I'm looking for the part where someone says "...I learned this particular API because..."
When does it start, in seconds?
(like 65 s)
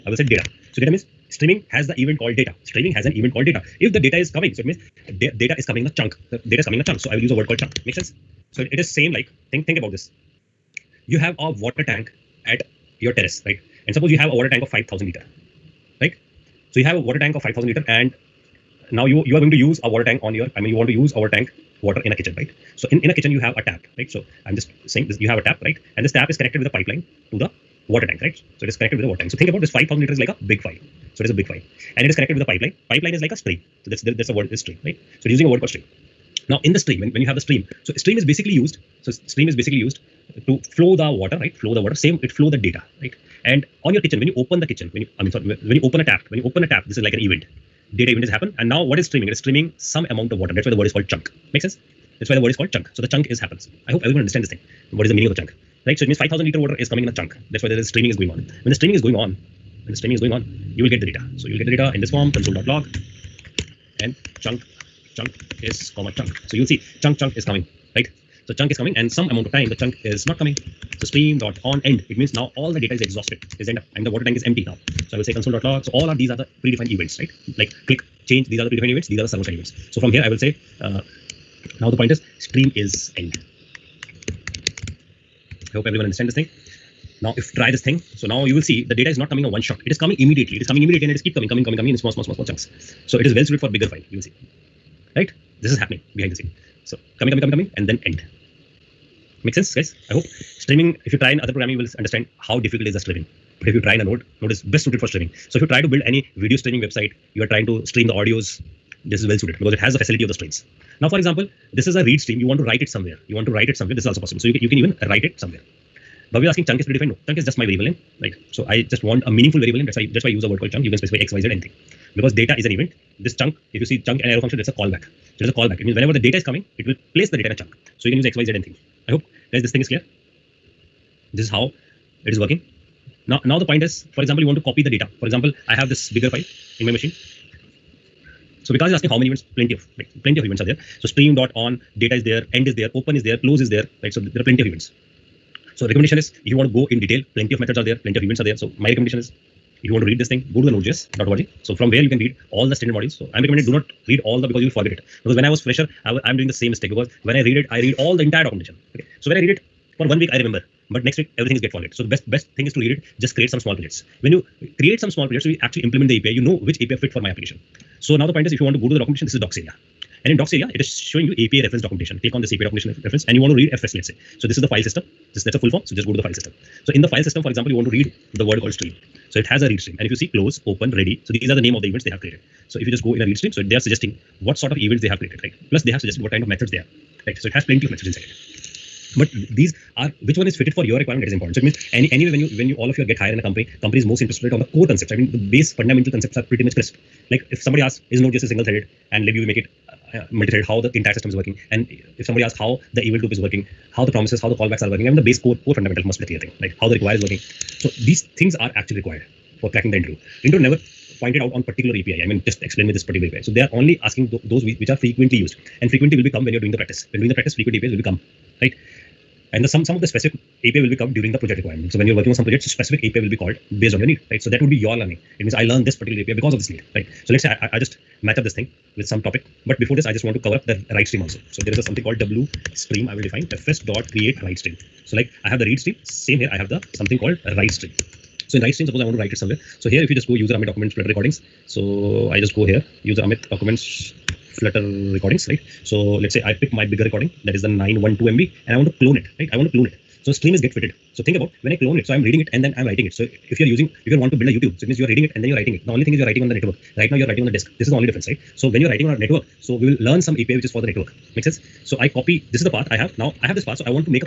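225 s.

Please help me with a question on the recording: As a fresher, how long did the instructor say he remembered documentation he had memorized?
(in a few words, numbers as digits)
one week.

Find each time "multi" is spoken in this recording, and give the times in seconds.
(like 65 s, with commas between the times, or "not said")
200 s.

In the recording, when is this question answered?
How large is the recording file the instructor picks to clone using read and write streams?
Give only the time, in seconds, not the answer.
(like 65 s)
247 s.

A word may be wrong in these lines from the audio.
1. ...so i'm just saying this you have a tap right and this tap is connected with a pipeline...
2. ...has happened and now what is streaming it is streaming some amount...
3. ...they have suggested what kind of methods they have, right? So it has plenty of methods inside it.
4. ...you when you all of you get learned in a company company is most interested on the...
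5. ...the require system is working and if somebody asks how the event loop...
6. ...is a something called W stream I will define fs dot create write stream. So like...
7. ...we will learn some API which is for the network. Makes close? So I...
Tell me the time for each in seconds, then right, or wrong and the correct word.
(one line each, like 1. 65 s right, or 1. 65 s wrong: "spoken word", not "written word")
1. 24 s right
2. 48 s right
3. 185 s right
4. 192 s wrong: "hired", not "learned"
5. 200 s wrong: "entire", not "require"
6. 231 s right
7. 259 s wrong: "sense", not "close".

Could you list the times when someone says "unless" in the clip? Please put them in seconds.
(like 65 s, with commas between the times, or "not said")
not said.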